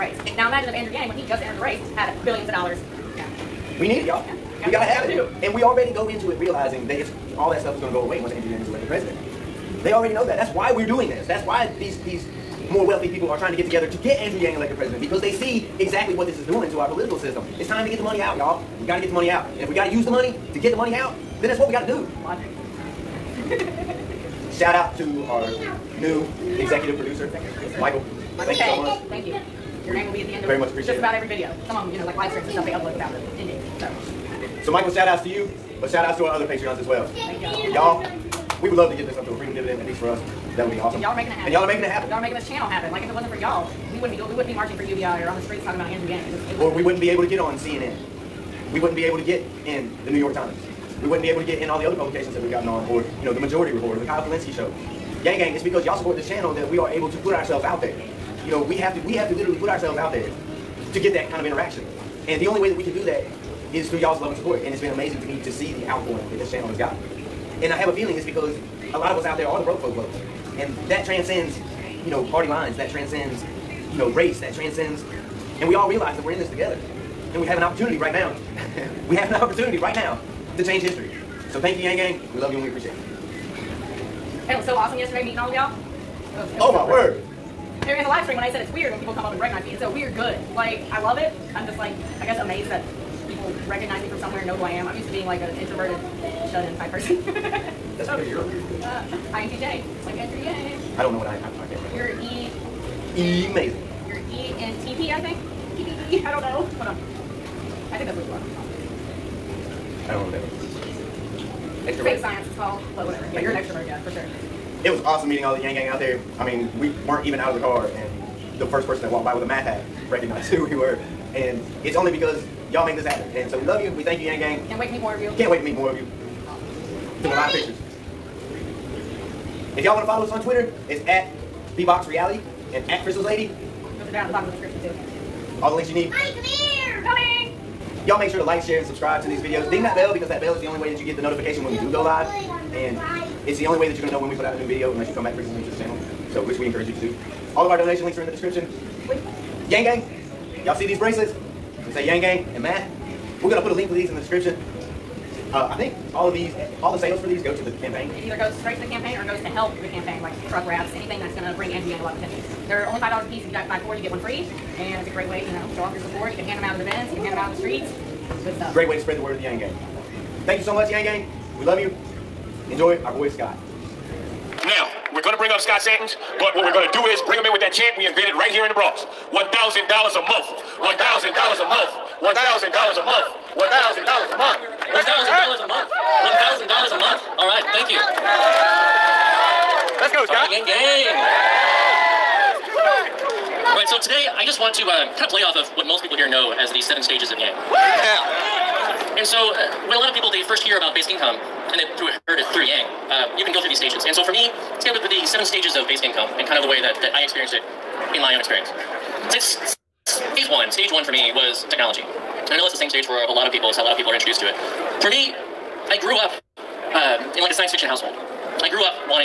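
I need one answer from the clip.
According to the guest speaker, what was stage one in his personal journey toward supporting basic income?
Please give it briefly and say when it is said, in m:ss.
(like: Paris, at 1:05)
technology, at 3:31.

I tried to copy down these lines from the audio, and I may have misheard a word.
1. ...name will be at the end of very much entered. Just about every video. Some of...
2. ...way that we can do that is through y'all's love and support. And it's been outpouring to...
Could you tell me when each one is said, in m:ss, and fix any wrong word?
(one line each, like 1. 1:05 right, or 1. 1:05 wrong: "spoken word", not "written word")
1. 0:29 wrong: "appreciated", not "entered"
2. 1:02 wrong: "amazing", not "outpouring".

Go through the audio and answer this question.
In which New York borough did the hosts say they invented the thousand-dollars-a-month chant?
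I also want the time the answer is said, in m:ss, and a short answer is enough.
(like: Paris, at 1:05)
the Bronx, at 2:58.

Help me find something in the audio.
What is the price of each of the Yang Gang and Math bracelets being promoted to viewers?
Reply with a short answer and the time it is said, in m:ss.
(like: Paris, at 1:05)
$5, at 2:42.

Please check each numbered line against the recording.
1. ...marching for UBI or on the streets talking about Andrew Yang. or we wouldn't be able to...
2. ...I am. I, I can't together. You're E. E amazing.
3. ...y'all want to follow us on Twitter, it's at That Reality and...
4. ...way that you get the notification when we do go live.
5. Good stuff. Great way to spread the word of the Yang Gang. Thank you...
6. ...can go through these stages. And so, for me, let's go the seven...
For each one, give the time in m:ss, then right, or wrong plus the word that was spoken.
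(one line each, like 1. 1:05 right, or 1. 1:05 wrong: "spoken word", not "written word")
1. 0:44 right
2. 1:41 wrong: "remember", not "together"
3. 2:09 wrong: "Bbox", not "That"
4. 2:20 right
5. 2:48 right
6. 3:23 right.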